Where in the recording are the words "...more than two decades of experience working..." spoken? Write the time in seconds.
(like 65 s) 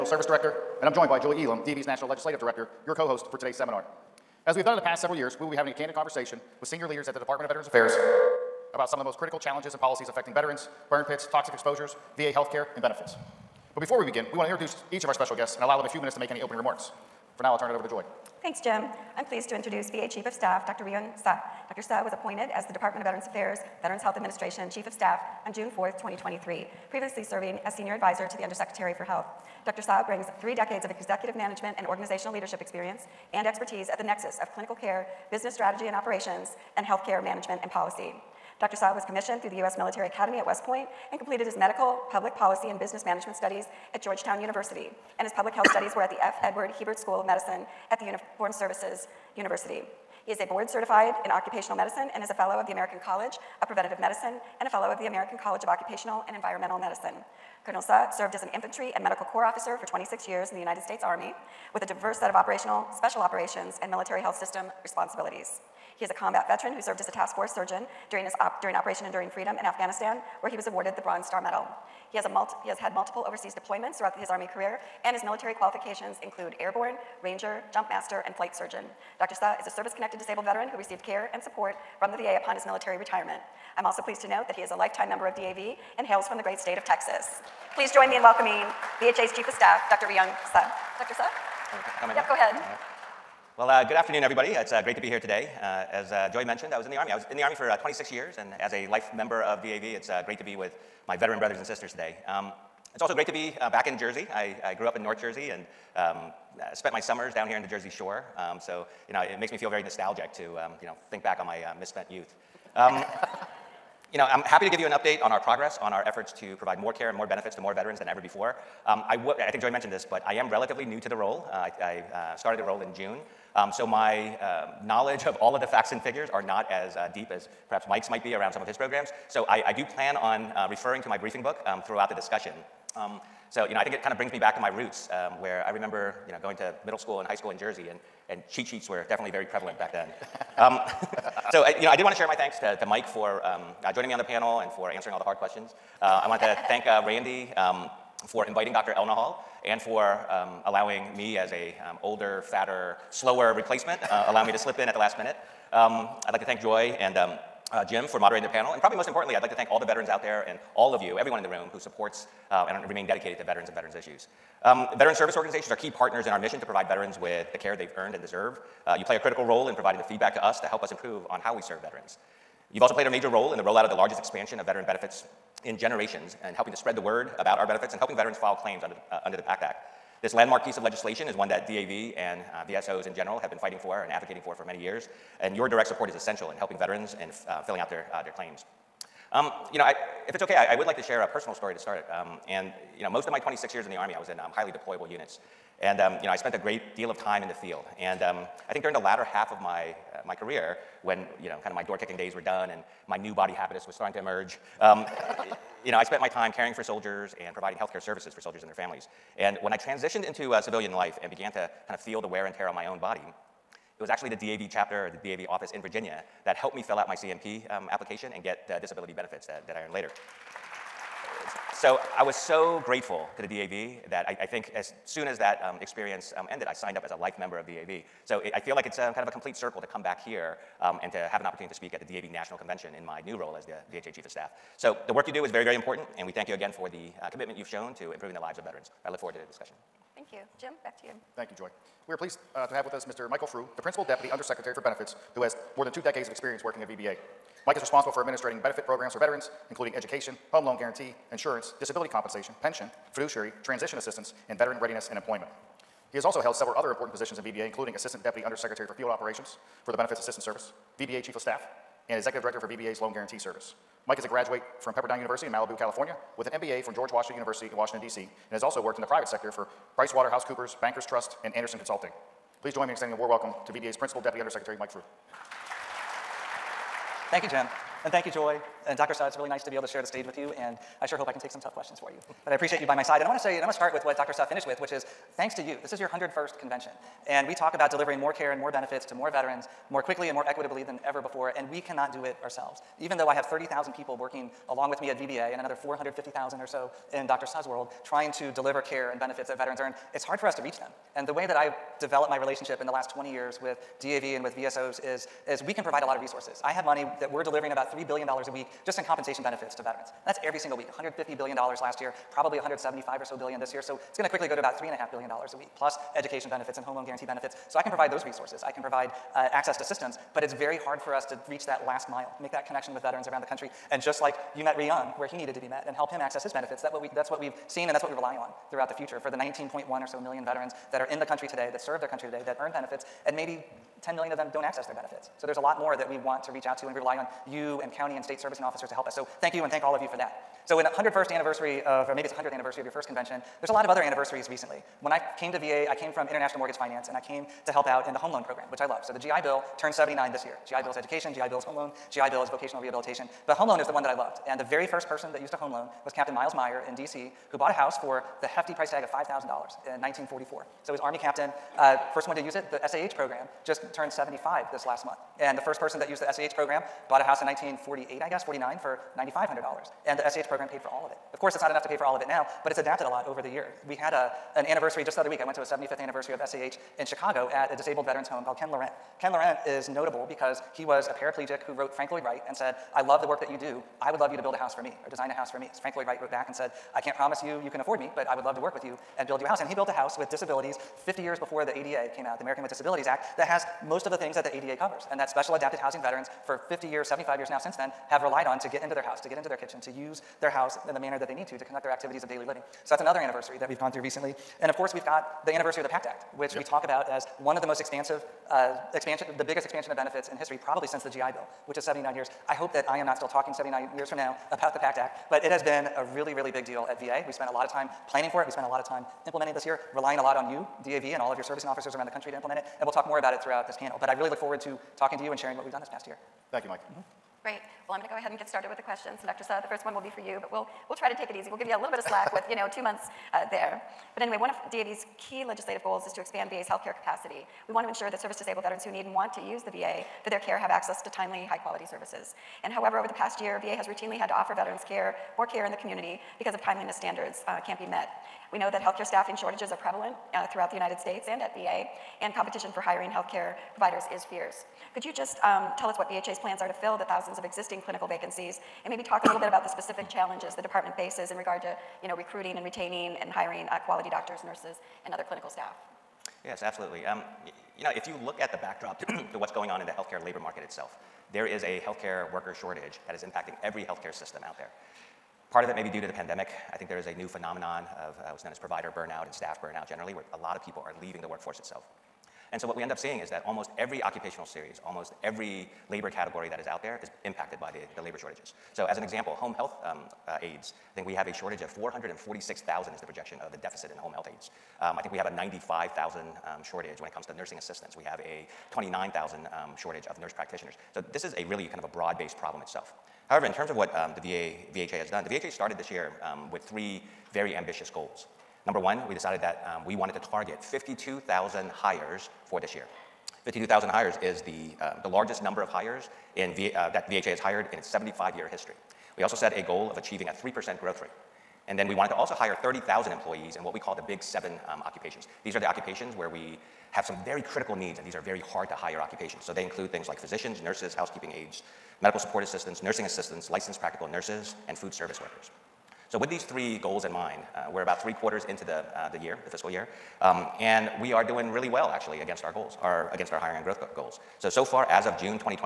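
245 s.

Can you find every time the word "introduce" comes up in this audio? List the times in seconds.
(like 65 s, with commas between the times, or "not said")
14 s, 19 s.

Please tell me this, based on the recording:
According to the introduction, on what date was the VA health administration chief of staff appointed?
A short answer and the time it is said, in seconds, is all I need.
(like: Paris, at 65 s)
June 4, 2023, at 25 s.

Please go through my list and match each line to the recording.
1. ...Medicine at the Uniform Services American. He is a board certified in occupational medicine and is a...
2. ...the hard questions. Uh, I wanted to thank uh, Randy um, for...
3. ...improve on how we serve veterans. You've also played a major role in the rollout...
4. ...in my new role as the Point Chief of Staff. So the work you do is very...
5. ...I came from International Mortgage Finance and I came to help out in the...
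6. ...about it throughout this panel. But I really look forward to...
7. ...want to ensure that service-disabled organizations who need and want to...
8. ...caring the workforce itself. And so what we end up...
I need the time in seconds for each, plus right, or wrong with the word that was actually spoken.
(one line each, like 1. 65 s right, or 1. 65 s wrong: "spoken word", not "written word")
1. 47 s wrong: "University", not "American"
2. 145 s right
3. 170 s right
4. 232 s wrong: "VHA", not "Point"
5. 345 s right
6. 423 s right
7. 437 s wrong: "veterans", not "organizations"
8. 481 s wrong: "leaving", not "caring".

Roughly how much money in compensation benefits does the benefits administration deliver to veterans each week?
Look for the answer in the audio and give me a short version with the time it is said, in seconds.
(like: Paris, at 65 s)
$3 billion, at 307 s.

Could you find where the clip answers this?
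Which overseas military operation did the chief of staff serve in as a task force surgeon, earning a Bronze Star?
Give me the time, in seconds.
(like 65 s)
68 s.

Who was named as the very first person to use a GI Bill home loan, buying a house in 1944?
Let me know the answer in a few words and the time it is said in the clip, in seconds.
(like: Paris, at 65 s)
Miles Meyer, at 356 s.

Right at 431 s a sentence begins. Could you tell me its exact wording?
We'll give you a little bit of slack with you know two months uh, there.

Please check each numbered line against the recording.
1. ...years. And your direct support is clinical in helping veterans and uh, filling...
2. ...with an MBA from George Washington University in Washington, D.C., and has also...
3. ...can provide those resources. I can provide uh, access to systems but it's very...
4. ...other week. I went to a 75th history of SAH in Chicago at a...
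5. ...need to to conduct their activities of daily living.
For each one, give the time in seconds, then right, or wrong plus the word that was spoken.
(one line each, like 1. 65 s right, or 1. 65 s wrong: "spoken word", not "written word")
1. 184 s wrong: "essential", not "clinical"
2. 266 s right
3. 317 s right
4. 375 s wrong: "anniversary", not "history"
5. 401 s right.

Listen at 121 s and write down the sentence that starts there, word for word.
Uh, I, I uh, started the role in June.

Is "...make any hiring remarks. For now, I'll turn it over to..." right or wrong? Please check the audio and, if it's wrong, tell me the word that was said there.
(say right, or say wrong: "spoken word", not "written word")
wrong: "opening", not "hiring".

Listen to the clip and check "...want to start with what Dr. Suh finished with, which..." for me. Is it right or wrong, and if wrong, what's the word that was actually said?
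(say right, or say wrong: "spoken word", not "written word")
right.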